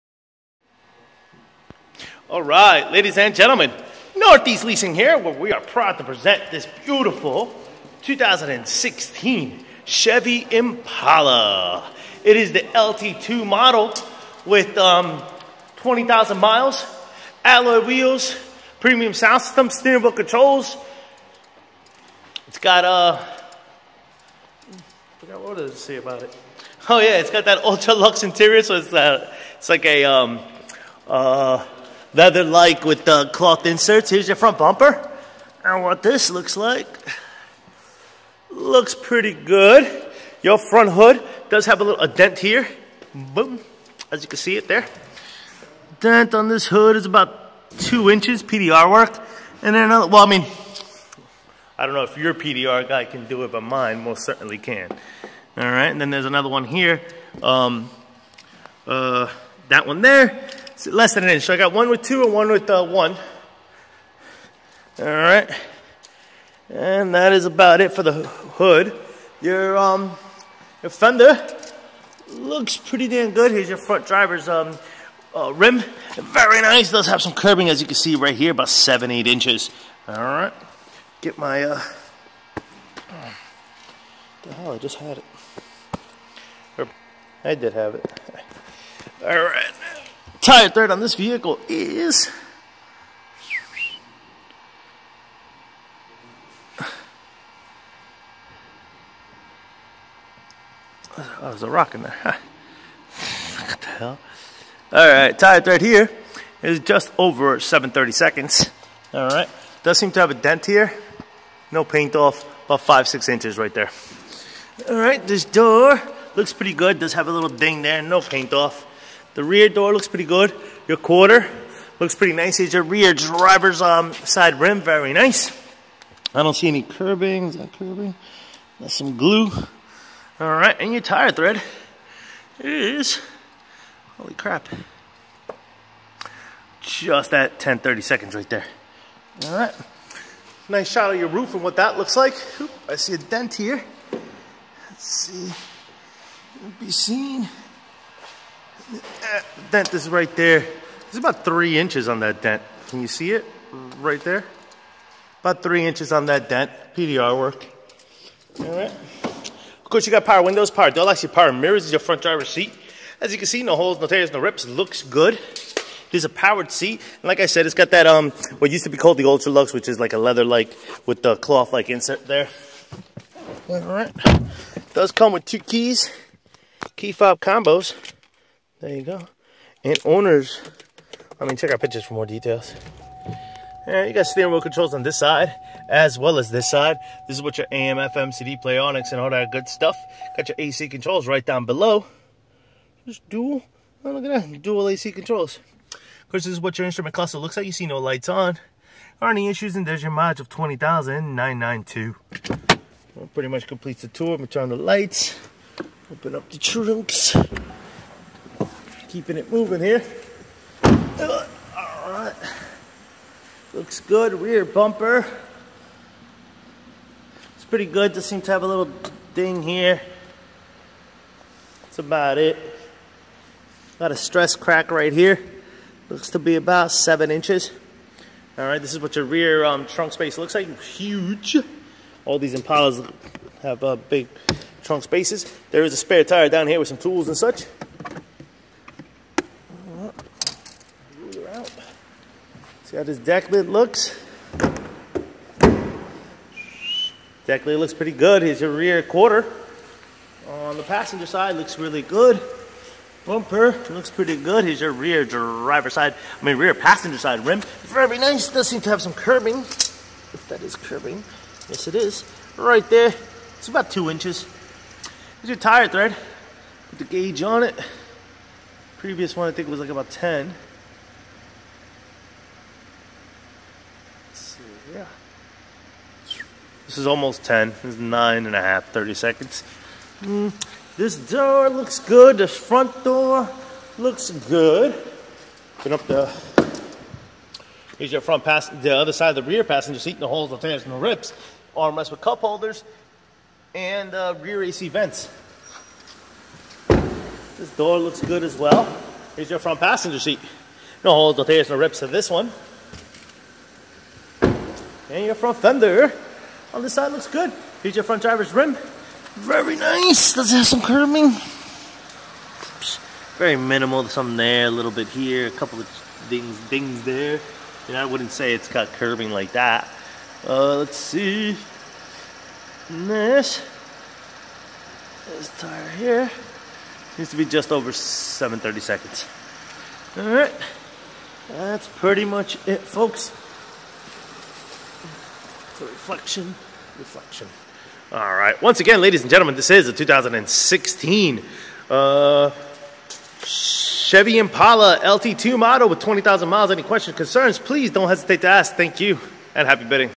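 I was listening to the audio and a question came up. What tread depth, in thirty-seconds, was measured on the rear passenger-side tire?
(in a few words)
9.5/32.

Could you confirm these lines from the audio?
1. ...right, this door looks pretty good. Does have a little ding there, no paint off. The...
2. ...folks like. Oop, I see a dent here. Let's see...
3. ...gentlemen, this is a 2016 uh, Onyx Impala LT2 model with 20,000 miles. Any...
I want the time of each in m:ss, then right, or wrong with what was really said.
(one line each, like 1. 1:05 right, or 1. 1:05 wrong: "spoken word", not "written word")
1. 1:54 right
2. 2:21 wrong: "looks", not "folks"
3. 5:39 wrong: "Chevy", not "Onyx".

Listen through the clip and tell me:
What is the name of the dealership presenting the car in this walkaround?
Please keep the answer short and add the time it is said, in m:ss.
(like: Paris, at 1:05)
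Northeast Leasing, at 0:04.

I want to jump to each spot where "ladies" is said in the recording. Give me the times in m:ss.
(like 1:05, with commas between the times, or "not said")
0:02, 5:39.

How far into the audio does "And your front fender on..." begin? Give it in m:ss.
5:05.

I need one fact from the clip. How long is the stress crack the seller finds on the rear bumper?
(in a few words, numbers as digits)
7 inches.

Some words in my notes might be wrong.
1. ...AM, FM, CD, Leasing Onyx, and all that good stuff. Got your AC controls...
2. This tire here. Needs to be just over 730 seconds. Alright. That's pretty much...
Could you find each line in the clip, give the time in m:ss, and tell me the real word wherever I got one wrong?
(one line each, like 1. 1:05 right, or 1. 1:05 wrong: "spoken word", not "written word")
1. 3:07 wrong: "Play", not "Leasing"
2. 5:25 right.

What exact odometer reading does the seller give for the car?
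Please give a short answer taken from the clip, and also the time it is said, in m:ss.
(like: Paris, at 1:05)
20,992, at 3:20.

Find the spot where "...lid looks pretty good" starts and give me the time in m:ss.
4:07.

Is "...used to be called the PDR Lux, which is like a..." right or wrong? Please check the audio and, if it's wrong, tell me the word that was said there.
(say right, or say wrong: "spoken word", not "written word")
wrong: "Ultra", not "PDR".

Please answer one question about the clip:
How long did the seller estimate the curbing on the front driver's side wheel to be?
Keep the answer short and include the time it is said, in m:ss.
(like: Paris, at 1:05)
7-8 inches, at 1:18.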